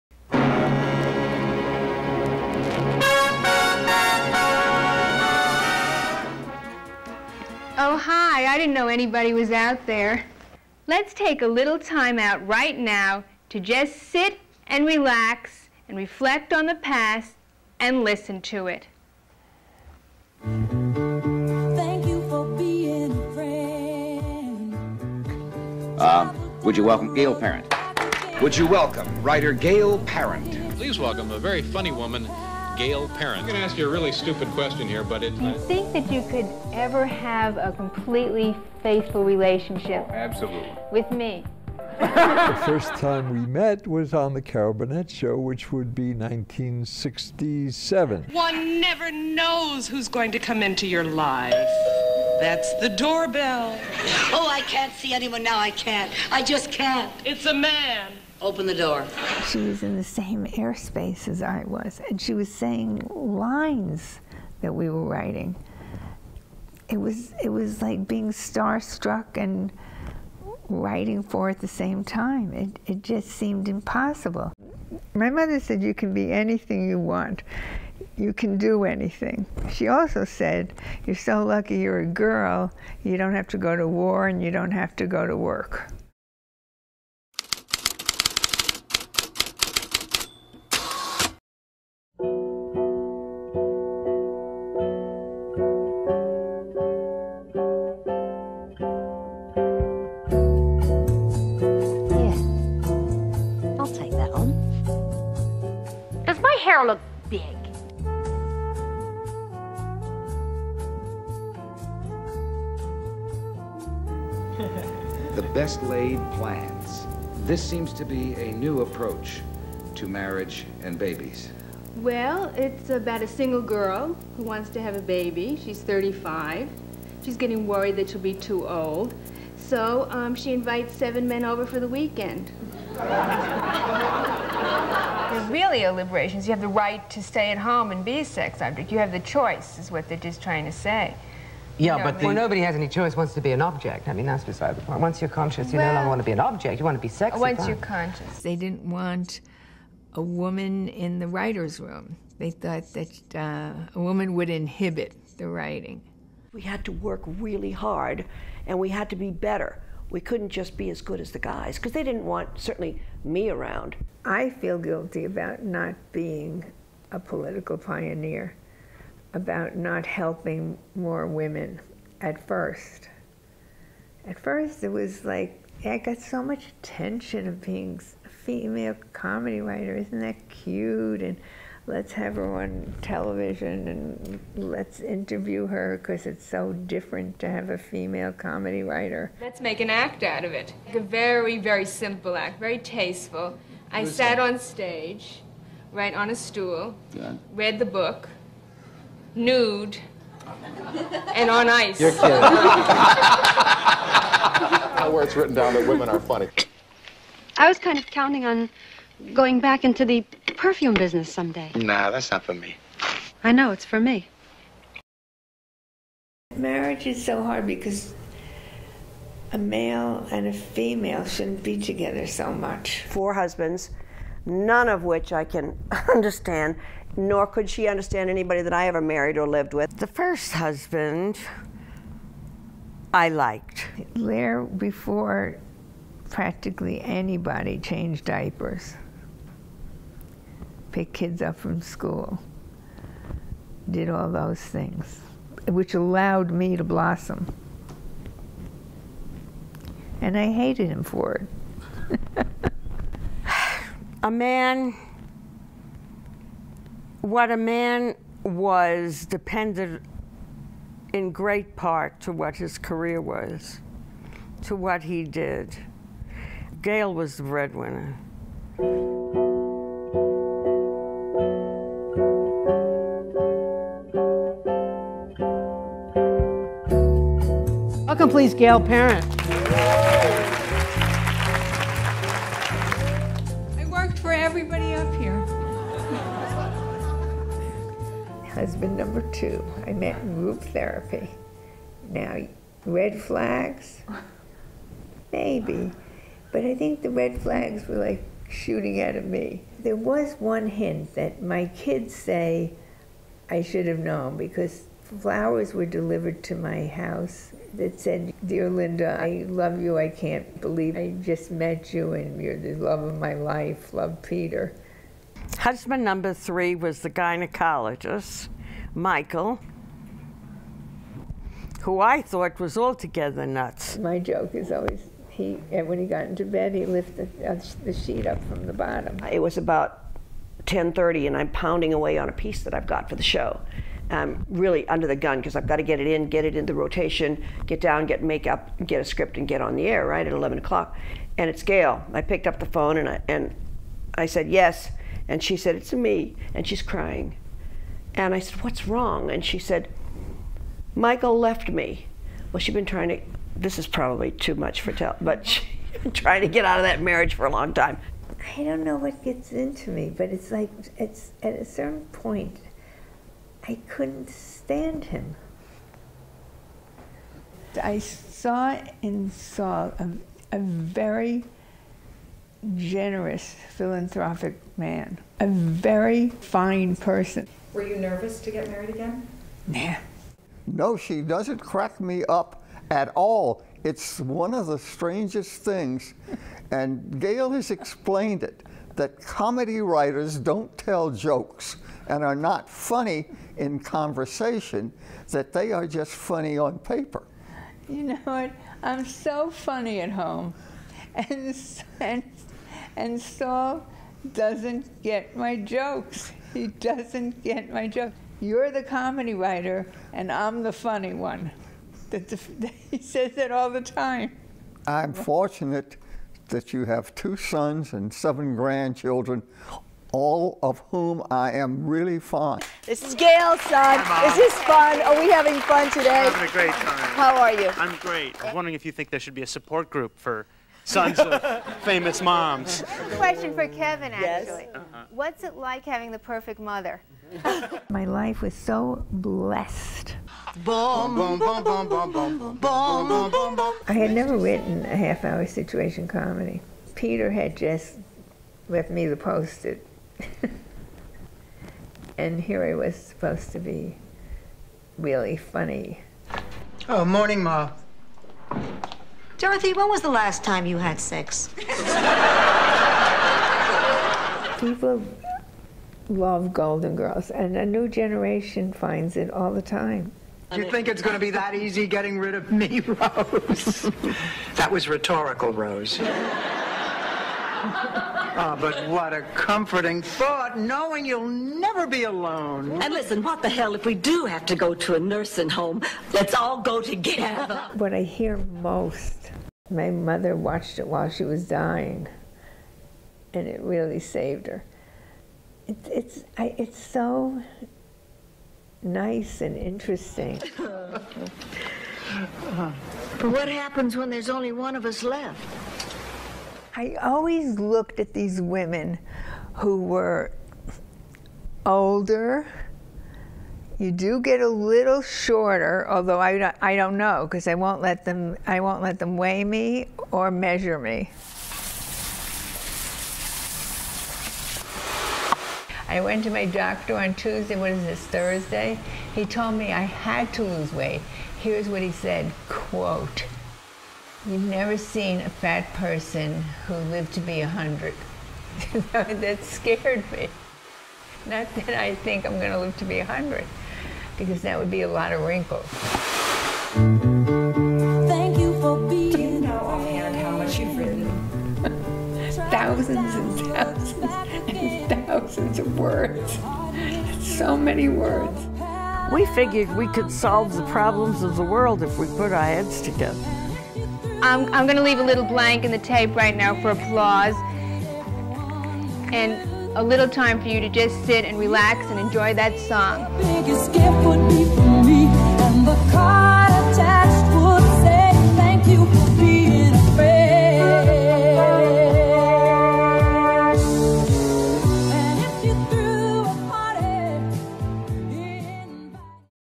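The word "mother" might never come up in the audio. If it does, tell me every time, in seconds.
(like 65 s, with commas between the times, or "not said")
75 s, 436 s, 489 s.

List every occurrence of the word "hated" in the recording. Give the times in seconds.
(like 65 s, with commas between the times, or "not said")
250 s.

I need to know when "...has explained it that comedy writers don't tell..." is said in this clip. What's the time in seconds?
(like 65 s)
387 s.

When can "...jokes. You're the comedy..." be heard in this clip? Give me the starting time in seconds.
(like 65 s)
407 s.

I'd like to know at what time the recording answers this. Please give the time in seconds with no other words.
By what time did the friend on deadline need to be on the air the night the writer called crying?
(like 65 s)
340 s.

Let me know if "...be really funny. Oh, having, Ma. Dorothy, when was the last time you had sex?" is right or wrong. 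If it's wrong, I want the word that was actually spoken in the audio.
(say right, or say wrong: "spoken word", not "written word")
wrong: "morning", not "having".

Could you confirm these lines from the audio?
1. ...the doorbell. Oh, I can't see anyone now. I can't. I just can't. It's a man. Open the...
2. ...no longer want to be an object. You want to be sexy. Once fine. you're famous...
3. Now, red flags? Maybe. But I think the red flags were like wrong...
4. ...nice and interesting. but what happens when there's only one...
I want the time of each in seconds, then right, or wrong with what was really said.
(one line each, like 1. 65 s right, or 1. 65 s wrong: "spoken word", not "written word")
1. 52 s right
2. 145 s wrong: "conscious", not "famous"
3. 292 s wrong: "shooting", not "wrong"
4. 498 s right.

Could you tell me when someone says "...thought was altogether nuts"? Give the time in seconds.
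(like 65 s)
322 s.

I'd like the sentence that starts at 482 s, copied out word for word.
And listen, what the hell, if we do have to go to a nursing home, let's all go together.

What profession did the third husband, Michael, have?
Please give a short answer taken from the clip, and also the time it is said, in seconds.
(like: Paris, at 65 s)
Gynecologist, at 317 s.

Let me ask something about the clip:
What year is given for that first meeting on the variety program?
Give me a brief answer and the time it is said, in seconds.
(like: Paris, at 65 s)
1967, at 46 s.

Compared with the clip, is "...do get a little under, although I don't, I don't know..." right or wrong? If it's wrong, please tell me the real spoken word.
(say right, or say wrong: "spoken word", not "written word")
wrong: "shorter", not "under".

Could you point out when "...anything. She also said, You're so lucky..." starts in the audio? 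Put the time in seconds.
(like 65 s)
78 s.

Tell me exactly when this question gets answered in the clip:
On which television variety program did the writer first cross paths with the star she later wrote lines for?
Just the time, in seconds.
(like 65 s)
44 s.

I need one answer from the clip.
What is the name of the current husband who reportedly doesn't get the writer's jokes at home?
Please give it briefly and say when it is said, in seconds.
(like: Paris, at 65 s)
Saul, at 403 s.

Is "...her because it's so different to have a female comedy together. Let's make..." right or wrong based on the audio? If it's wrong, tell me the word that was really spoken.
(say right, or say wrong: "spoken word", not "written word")
wrong: "writer", not "together".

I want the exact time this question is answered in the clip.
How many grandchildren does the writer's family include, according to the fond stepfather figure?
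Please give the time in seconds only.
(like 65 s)
418 s.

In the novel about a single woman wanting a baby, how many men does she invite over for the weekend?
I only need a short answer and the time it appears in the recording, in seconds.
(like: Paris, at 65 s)
7, at 130 s.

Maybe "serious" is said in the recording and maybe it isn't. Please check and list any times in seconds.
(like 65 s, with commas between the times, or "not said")
not said.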